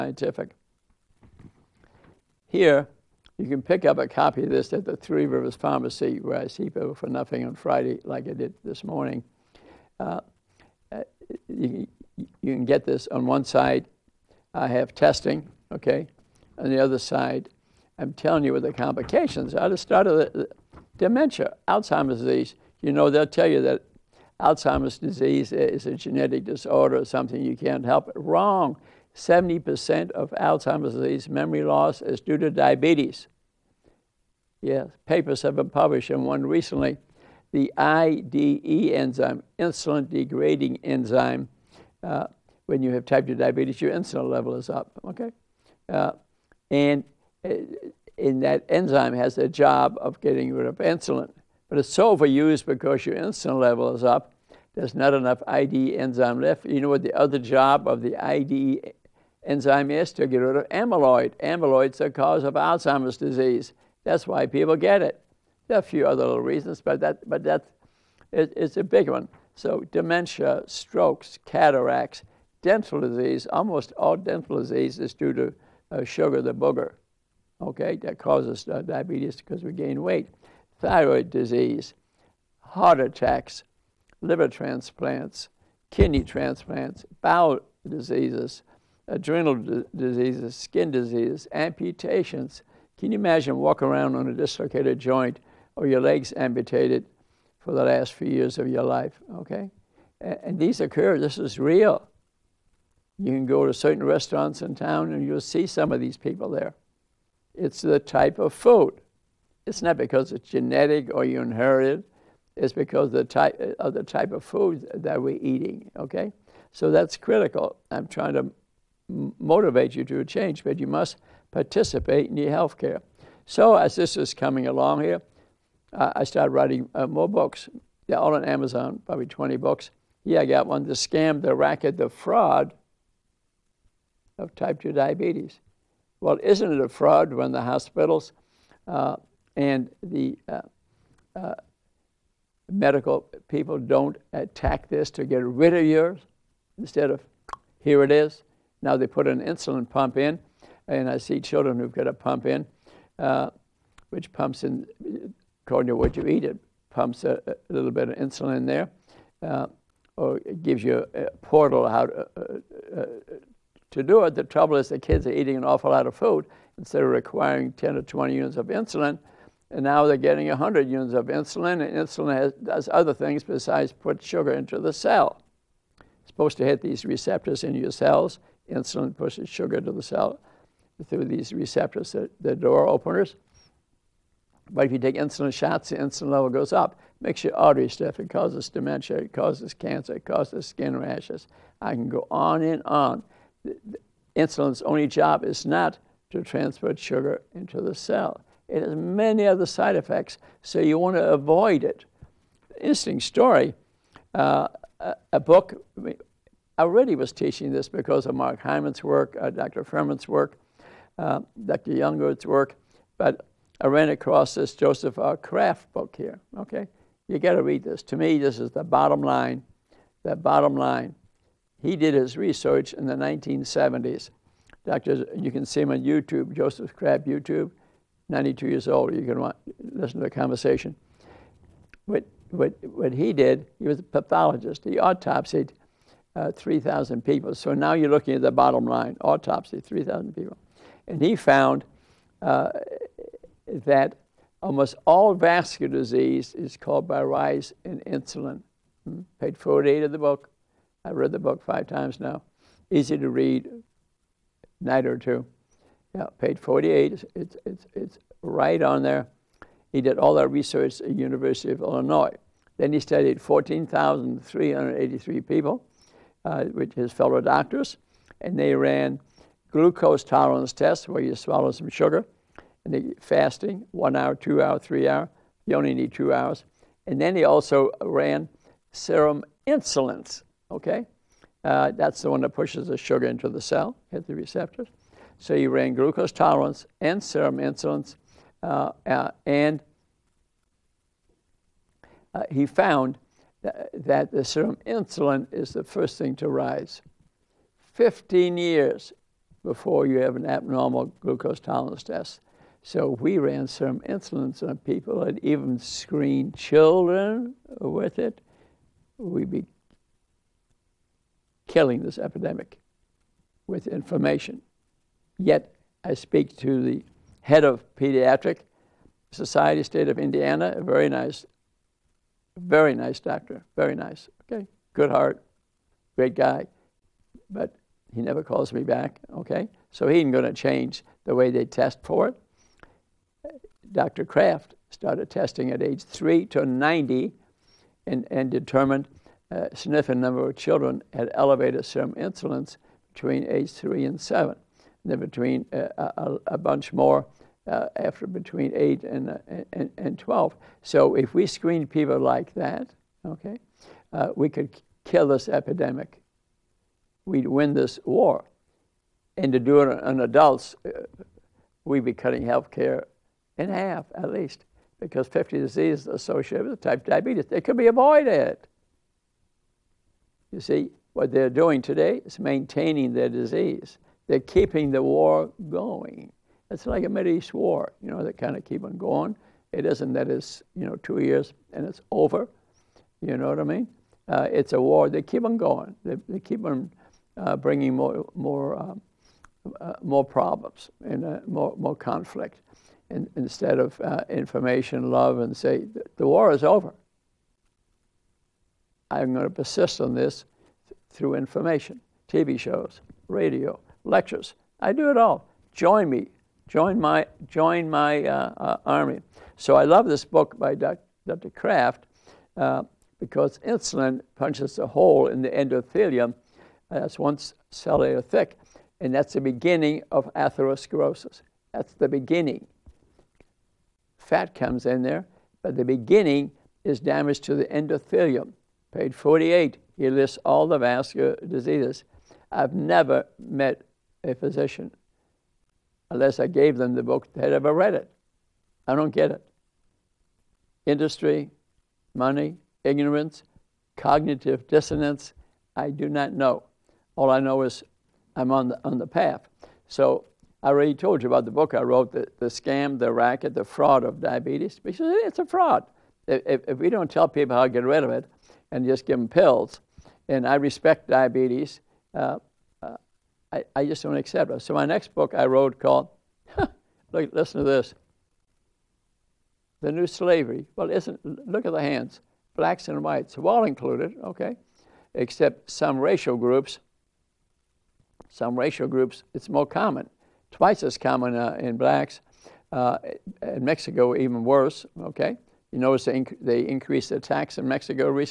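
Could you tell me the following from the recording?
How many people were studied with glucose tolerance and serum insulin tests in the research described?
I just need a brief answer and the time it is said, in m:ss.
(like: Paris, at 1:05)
14,383, at 4:23.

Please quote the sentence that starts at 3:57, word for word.
So now you're looking at the bottom line autopsy, 3,000 people.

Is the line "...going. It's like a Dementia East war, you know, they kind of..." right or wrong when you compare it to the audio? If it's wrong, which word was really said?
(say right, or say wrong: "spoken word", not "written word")
wrong: "Middle", not "Dementia".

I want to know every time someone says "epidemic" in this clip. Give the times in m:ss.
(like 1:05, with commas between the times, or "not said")
5:12, 5:55.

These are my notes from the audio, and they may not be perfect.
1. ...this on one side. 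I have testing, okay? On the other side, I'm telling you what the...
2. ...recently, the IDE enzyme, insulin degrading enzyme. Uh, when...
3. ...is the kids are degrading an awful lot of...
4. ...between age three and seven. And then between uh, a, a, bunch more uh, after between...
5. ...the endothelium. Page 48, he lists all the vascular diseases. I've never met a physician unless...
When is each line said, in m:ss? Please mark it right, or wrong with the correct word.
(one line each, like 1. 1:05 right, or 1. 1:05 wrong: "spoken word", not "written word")
1. 0:12 right
2. 0:36 right
3. 2:44 wrong: "eating", not "degrading"
4. 5:43 right
5. 7:07 right.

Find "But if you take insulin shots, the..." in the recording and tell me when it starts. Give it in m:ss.
3:04.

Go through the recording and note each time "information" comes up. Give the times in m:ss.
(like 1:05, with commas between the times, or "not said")
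5:13, 6:34, 6:41.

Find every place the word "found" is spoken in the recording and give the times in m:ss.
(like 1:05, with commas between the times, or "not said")
4:01, 4:52.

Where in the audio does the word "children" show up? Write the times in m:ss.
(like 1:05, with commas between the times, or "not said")
2:31, 5:06, 5:40.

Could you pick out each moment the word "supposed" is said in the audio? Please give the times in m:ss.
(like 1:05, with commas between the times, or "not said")
2:56.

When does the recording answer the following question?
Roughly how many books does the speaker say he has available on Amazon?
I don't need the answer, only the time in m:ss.
2:09.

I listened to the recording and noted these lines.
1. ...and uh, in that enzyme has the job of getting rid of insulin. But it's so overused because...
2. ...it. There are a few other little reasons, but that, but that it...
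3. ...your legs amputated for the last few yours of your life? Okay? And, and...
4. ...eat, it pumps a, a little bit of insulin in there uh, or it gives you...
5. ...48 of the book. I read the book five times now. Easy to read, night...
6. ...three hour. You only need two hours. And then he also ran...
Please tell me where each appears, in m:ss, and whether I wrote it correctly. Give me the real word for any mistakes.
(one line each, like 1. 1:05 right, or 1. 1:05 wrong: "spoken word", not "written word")
1. 0:46 right
2. 1:05 right
3. 1:35 wrong: "years", not "yours"
4. 2:36 right
5. 4:09 right
6. 4:34 right.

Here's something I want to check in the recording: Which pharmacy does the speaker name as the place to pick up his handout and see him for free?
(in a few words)
Three Rivers Pharmacy.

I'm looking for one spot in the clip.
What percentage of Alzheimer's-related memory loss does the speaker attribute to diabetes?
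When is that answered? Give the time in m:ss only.
0:29.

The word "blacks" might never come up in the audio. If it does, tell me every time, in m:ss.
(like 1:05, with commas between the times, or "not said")
7:52, 8:01.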